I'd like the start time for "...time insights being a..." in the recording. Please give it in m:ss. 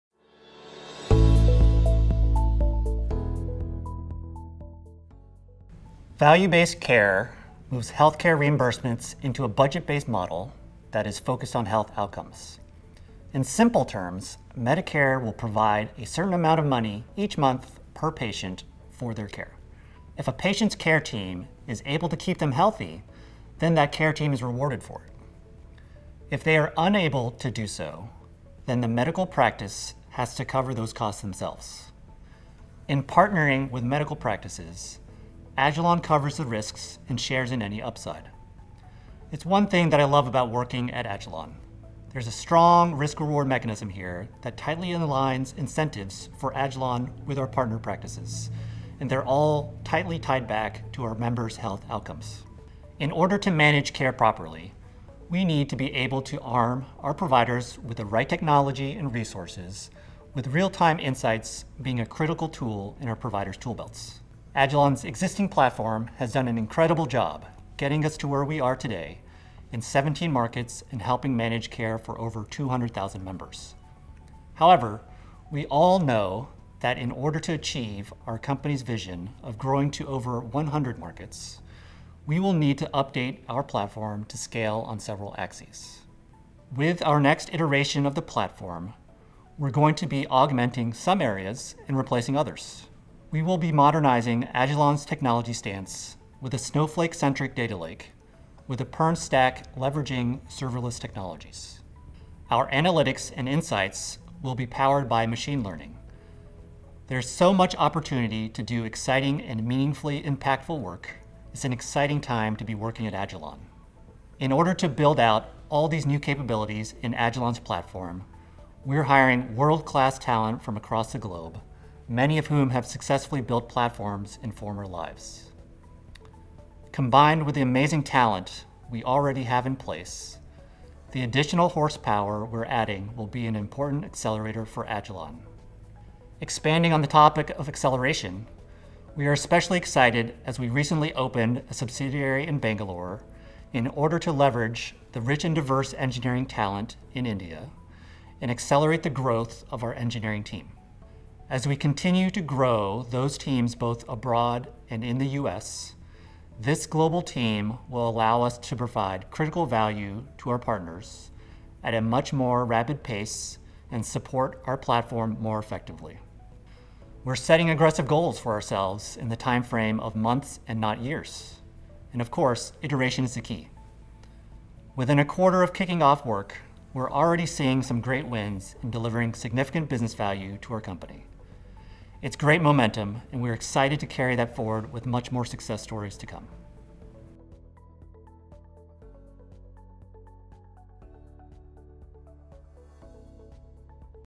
1:00.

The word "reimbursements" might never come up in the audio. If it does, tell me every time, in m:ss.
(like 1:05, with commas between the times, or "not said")
0:08.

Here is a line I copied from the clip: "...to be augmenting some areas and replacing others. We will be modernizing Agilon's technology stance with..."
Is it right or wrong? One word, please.
right.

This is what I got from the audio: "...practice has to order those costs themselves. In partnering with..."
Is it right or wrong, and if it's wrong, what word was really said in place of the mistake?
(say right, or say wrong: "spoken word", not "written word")
wrong: "cover", not "order".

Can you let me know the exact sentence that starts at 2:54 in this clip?
Within a quarter of kicking off work, we're already seeing some great wins in delivering significant business value to our company.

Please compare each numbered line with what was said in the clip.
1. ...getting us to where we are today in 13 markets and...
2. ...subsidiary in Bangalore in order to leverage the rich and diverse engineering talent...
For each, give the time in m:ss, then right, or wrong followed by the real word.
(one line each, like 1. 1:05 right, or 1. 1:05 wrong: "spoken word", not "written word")
1. 1:07 wrong: "17", not "13"
2. 2:21 right.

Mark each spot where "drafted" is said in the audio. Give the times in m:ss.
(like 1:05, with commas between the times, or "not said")
not said.